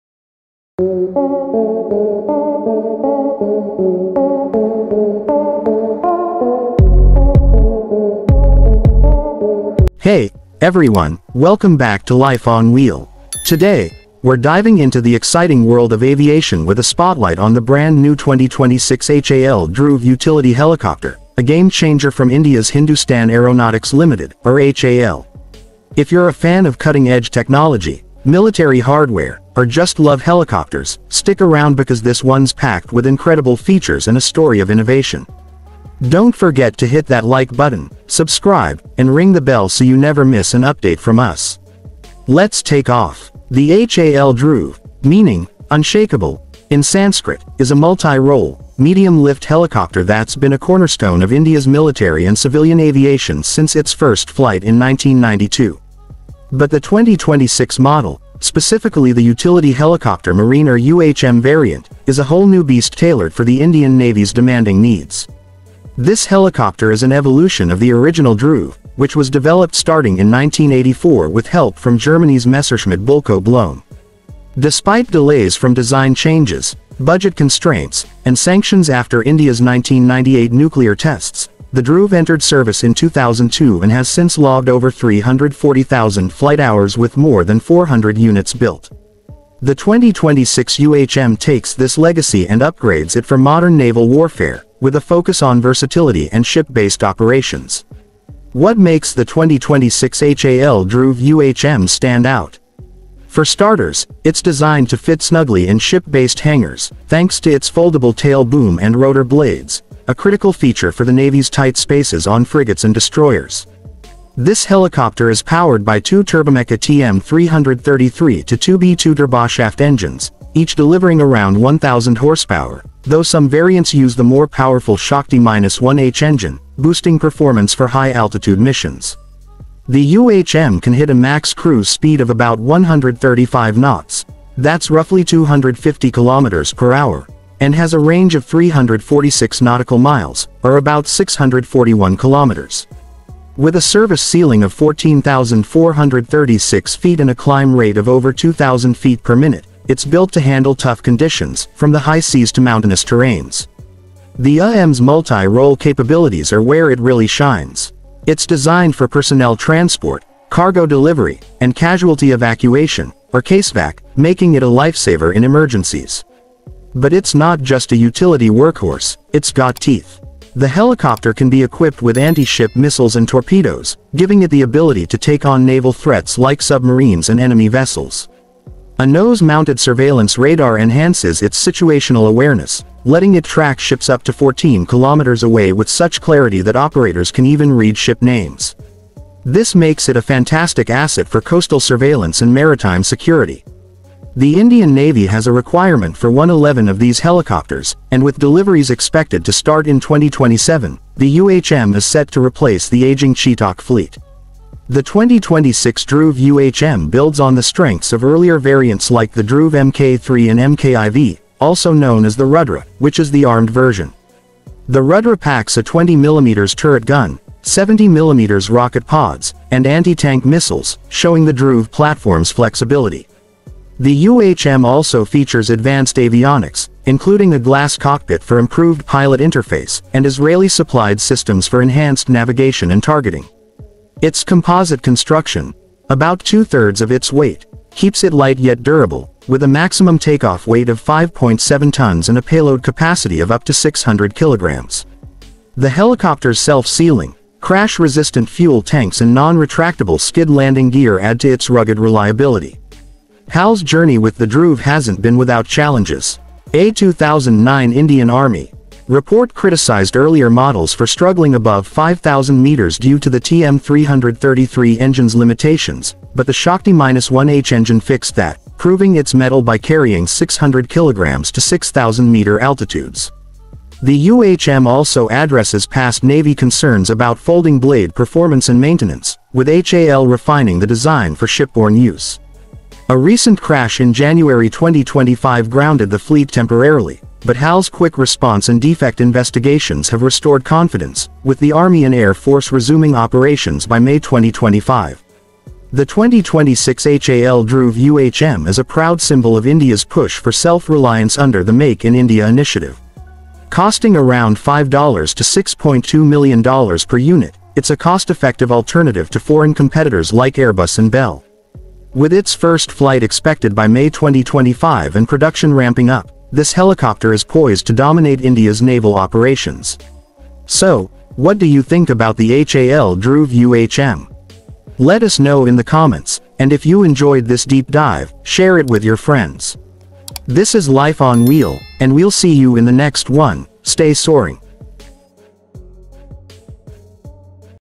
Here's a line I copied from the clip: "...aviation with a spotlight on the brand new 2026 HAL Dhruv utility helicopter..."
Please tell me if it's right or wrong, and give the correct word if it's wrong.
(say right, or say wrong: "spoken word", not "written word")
right.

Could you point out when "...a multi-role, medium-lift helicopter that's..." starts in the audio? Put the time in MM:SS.
00:47.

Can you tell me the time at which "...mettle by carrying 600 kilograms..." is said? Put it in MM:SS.
04:29.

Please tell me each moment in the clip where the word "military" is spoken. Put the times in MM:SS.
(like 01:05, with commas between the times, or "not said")
00:28, 00:51.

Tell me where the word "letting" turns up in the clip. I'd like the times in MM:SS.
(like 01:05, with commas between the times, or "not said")
03:03.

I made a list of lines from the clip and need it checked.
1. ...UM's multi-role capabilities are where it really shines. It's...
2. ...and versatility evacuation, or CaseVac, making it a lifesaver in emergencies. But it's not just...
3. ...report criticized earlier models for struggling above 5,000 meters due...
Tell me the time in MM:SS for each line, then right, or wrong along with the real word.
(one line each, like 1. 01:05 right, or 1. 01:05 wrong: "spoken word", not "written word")
1. 02:34 right
2. 02:41 wrong: "casualty", not "versatility"
3. 04:19 right.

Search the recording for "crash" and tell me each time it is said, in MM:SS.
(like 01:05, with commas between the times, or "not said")
04:07, 04:43.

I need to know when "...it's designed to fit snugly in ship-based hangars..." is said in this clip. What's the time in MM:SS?
01:44.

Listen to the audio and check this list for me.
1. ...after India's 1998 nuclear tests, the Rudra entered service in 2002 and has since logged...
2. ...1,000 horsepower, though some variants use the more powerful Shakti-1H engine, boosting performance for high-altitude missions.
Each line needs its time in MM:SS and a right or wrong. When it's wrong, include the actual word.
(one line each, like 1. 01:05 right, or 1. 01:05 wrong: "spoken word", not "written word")
1. 01:18 wrong: "Dhruv", not "Rudra"
2. 02:01 right.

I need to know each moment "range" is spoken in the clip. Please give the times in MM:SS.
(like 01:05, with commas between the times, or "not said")
02:17.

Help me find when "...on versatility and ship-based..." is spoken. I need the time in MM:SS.
01:35.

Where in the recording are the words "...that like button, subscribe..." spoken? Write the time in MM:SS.
00:37.